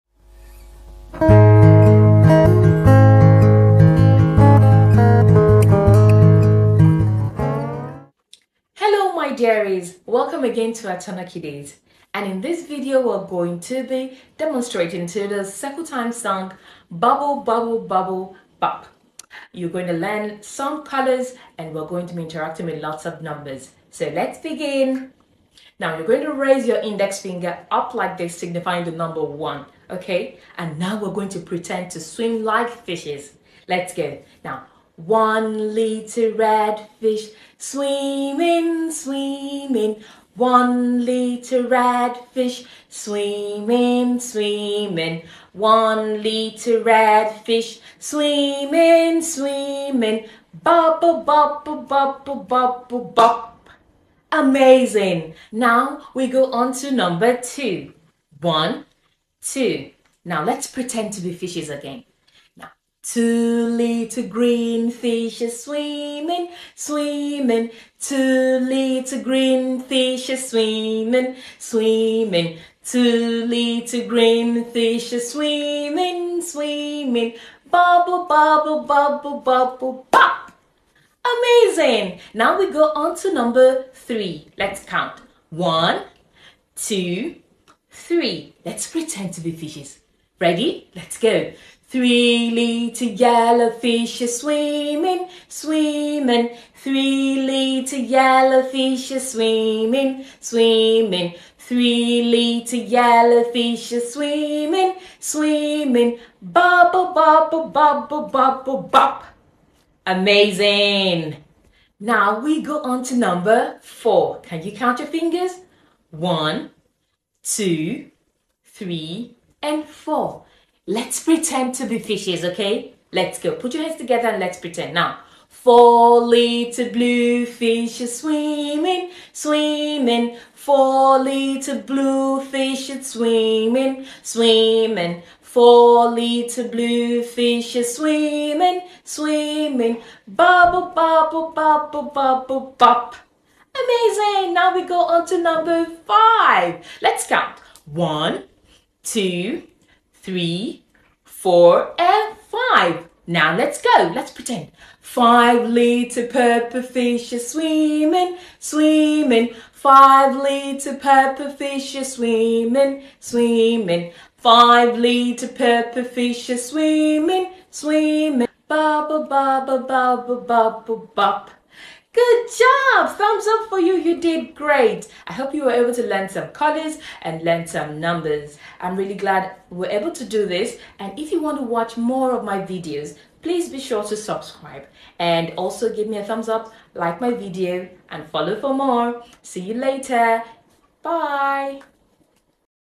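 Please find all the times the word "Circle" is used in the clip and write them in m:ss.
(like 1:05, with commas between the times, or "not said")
0:15.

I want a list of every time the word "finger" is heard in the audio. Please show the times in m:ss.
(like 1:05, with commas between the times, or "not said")
0:27, 1:55.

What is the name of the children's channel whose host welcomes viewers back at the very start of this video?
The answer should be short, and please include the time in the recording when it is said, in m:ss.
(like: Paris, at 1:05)
Atona Kiddies, at 0:10.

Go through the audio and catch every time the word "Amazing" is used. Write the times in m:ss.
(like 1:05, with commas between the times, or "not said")
0:54, 1:21, 1:50, 2:23.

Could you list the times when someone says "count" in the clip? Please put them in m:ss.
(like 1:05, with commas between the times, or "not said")
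1:24, 1:54, 2:27.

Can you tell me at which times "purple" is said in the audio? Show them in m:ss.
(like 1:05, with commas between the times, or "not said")
2:36, 2:40, 2:45.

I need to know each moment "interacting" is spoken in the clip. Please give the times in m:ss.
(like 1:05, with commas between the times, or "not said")
0:22.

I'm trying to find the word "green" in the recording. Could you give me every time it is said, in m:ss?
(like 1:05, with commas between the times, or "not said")
1:04, 1:09, 1:14.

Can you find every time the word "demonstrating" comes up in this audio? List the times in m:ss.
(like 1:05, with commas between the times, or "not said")
0:14.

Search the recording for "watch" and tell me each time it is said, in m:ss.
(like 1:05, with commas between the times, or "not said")
3:01.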